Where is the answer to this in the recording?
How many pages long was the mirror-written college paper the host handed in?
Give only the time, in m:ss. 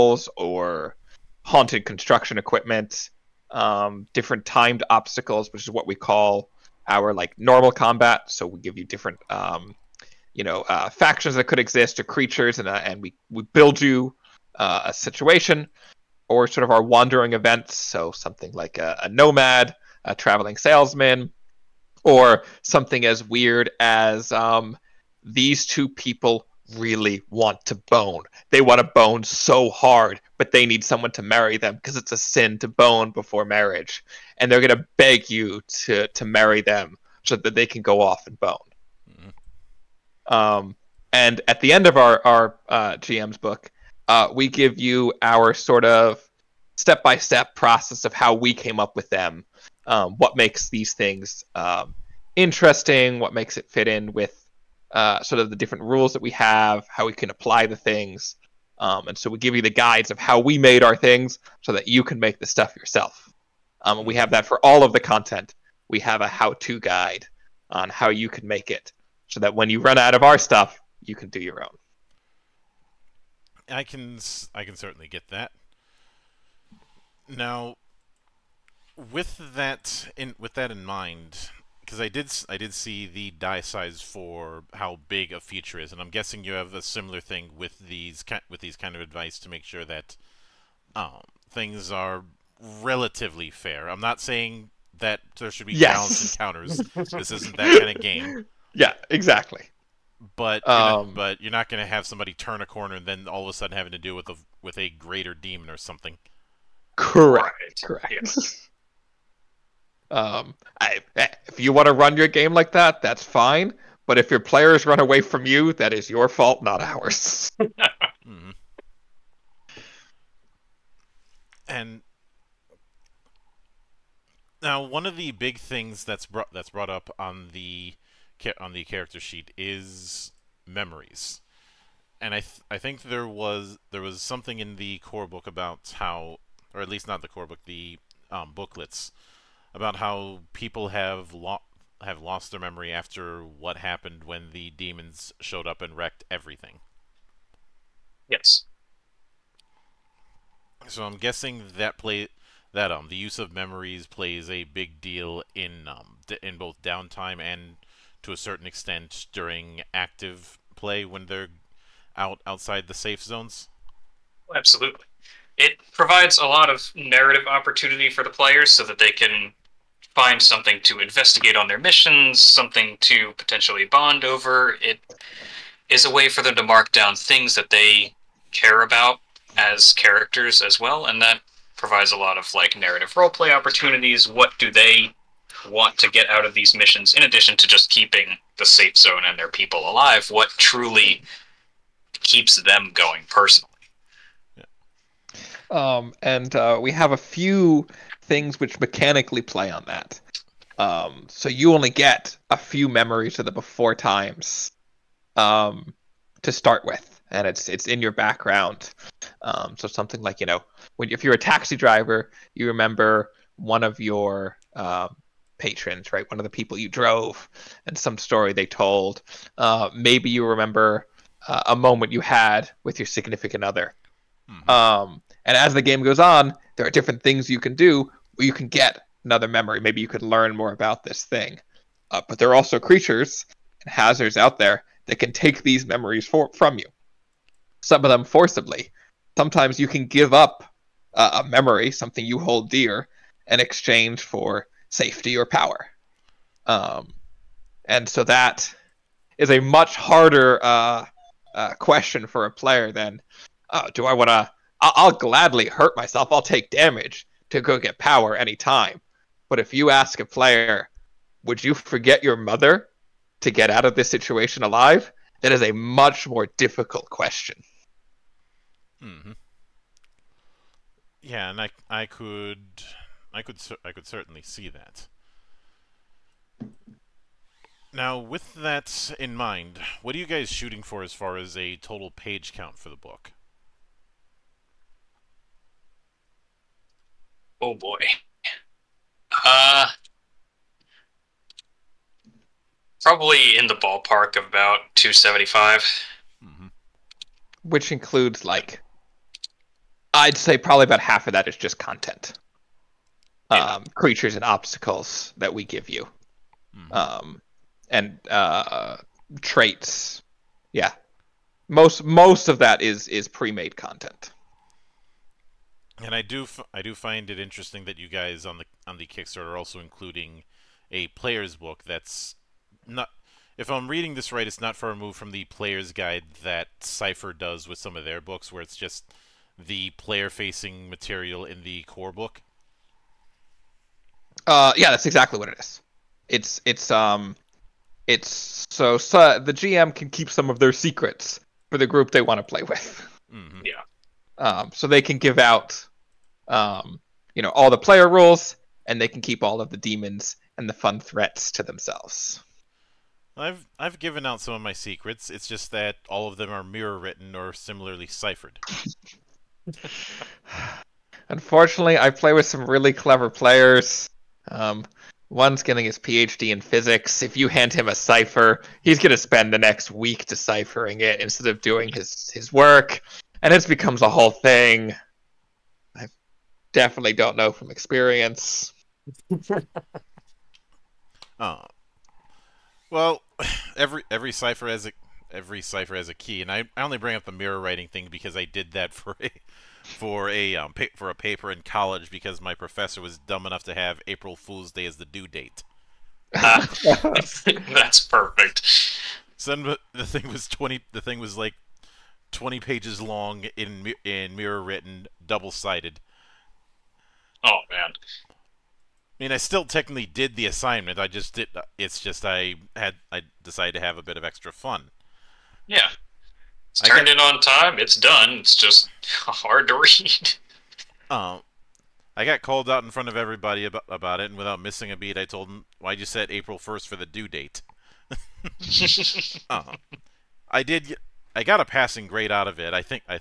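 6:42.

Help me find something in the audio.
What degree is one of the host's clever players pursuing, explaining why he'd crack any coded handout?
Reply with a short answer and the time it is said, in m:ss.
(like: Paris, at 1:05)
PhD in physics, at 6:05.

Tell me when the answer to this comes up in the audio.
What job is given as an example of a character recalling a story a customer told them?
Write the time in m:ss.
3:31.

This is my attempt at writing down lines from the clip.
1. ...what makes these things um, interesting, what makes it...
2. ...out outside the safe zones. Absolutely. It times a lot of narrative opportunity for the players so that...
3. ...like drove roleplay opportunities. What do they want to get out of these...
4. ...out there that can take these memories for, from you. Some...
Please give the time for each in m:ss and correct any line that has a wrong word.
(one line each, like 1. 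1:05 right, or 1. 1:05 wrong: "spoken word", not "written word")
1. 0:50 right
2. 2:42 wrong: "provides", not "times"
3. 3:02 wrong: "narrative", not "drove"
4. 3:54 right.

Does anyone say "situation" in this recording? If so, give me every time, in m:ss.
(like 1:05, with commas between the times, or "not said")
0:14, 4:24.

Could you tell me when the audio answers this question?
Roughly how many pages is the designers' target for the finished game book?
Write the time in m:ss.
4:54.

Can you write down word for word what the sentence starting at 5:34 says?
Uh, yeah, that's exactly what it is.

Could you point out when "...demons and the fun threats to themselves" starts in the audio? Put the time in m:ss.
5:49.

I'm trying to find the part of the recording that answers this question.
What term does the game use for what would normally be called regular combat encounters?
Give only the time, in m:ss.
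0:04.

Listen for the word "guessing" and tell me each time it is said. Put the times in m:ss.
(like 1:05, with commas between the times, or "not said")
1:26, 2:31.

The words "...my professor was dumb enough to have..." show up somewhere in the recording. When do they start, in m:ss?
6:32.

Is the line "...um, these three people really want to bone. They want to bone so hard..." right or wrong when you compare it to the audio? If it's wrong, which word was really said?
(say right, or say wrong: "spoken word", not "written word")
wrong: "two", not "three".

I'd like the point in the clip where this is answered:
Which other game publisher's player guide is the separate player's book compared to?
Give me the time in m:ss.
5:26.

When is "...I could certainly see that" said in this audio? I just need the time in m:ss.
4:33.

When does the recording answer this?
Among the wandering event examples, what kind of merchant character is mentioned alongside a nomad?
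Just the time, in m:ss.
0:20.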